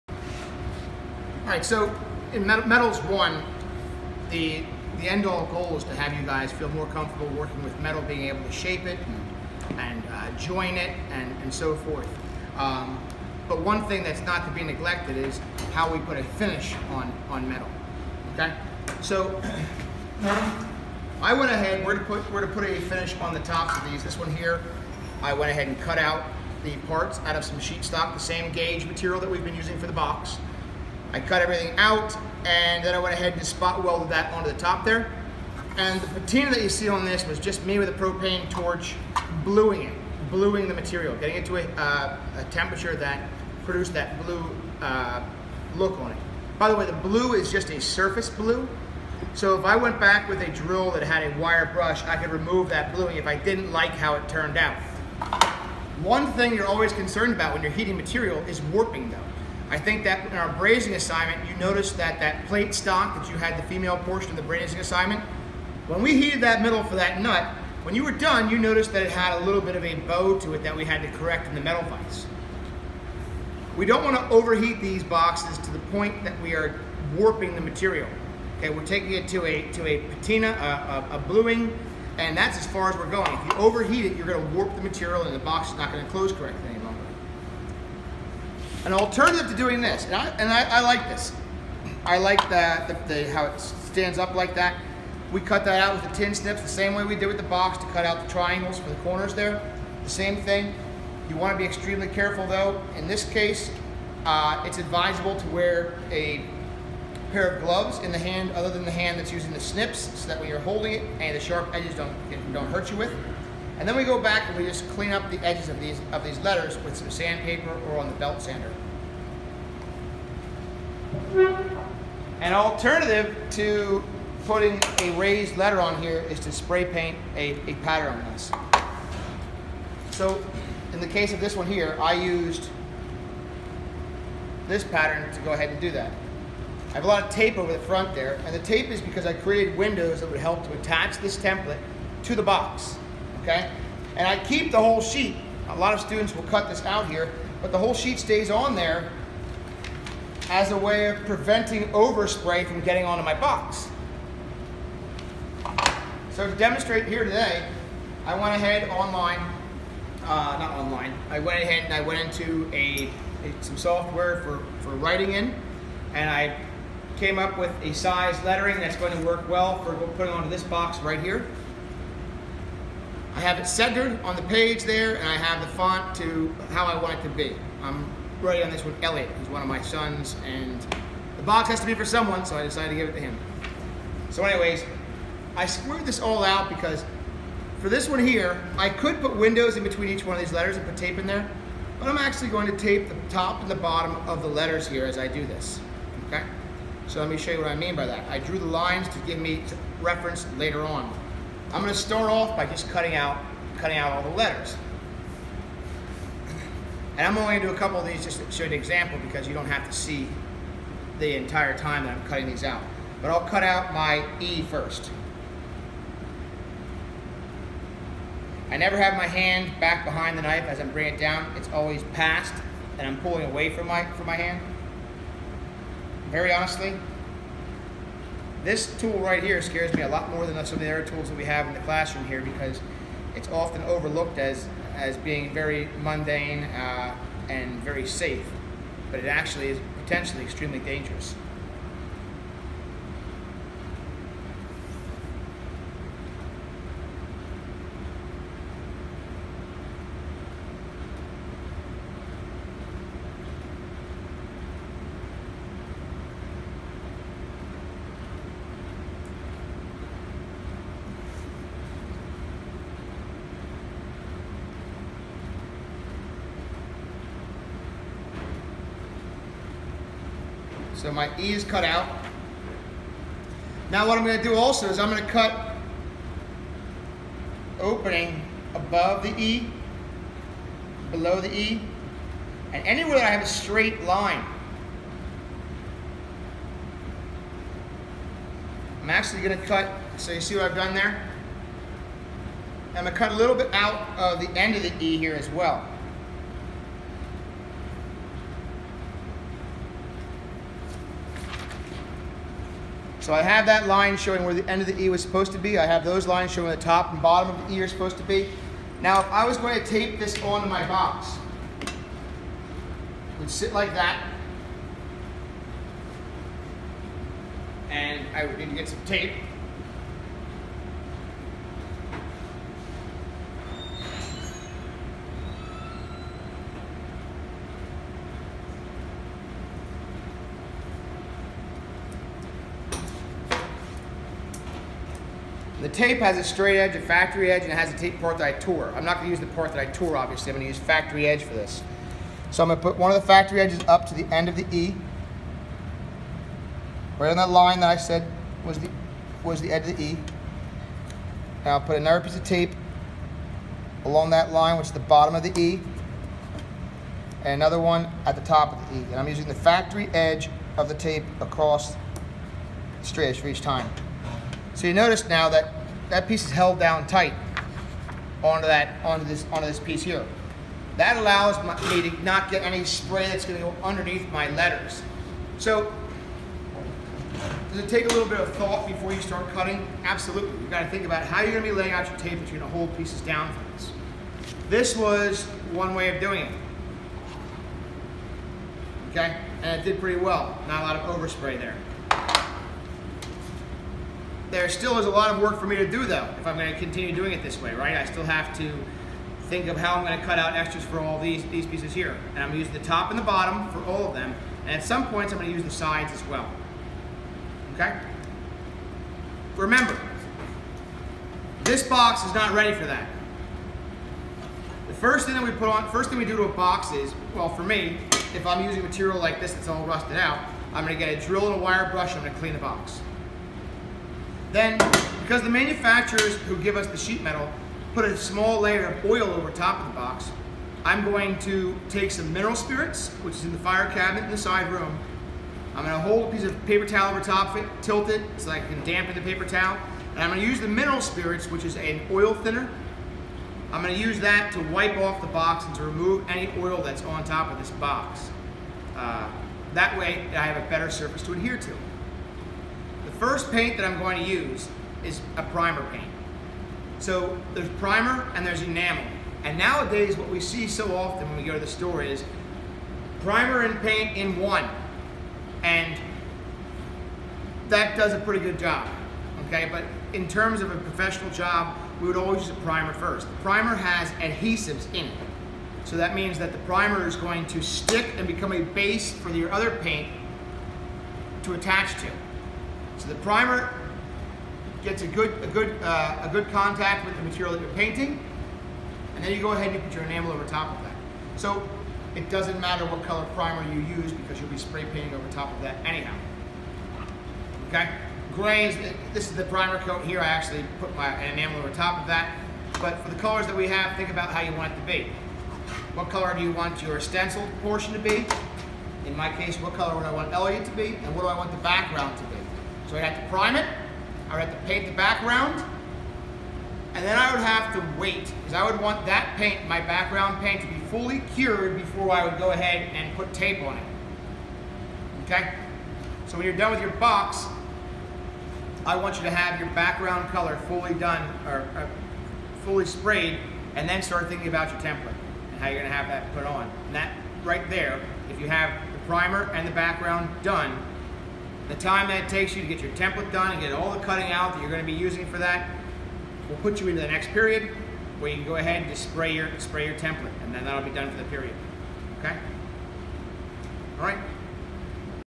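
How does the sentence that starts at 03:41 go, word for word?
It's always past and I'm pulling away from my, from my hand.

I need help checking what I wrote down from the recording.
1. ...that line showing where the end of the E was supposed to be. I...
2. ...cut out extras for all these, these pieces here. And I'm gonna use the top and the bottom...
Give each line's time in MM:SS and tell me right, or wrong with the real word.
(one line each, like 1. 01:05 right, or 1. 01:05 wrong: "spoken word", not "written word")
1. 05:03 right
2. 06:40 right.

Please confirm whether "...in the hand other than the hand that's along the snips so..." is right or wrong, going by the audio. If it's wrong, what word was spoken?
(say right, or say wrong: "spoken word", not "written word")
wrong: "using", not "along".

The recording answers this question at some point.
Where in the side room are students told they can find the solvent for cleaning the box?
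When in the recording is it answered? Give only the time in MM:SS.
07:13.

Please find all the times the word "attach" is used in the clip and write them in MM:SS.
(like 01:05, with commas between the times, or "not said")
02:20, 08:01.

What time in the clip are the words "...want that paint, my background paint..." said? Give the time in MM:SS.
08:38.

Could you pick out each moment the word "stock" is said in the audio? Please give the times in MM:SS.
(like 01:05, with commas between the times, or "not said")
00:27, 01:02.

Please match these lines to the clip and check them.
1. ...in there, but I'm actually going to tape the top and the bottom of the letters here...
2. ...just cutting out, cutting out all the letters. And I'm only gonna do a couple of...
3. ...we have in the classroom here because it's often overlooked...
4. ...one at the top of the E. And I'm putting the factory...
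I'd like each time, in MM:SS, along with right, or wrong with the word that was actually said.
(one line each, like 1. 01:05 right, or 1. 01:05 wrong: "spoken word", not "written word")
1. 03:11 right
2. 03:22 right
3. 03:51 right
4. 05:57 wrong: "using", not "putting".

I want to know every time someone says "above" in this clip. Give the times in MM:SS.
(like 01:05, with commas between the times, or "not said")
04:38.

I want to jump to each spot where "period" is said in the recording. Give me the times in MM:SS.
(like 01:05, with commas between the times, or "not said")
09:07, 09:11.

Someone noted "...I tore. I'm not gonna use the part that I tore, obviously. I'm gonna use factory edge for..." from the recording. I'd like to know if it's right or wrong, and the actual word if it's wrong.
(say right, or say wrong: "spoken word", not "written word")
right.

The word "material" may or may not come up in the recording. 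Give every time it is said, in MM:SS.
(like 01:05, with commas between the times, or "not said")
00:28, 00:40, 00:57, 01:17, 01:24, 06:58, 08:07.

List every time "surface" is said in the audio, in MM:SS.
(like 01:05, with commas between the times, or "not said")
00:47, 07:30.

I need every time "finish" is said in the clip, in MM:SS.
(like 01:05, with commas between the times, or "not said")
00:16, 00:22.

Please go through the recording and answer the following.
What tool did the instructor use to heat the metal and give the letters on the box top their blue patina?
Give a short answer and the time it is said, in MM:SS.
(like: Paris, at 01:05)
Propane torch, at 00:37.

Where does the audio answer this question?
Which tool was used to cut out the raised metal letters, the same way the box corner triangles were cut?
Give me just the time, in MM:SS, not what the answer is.
01:36.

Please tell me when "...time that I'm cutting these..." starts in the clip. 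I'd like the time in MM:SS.
03:31.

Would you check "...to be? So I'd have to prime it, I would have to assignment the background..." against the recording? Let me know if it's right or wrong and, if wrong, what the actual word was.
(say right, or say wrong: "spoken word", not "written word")
wrong: "paint", not "assignment".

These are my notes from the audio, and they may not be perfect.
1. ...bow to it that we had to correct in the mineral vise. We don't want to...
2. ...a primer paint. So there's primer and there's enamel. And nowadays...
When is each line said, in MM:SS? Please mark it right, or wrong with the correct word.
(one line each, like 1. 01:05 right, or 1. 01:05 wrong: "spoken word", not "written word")
1. 01:09 wrong: "metal", not "mineral"
2. 07:35 right.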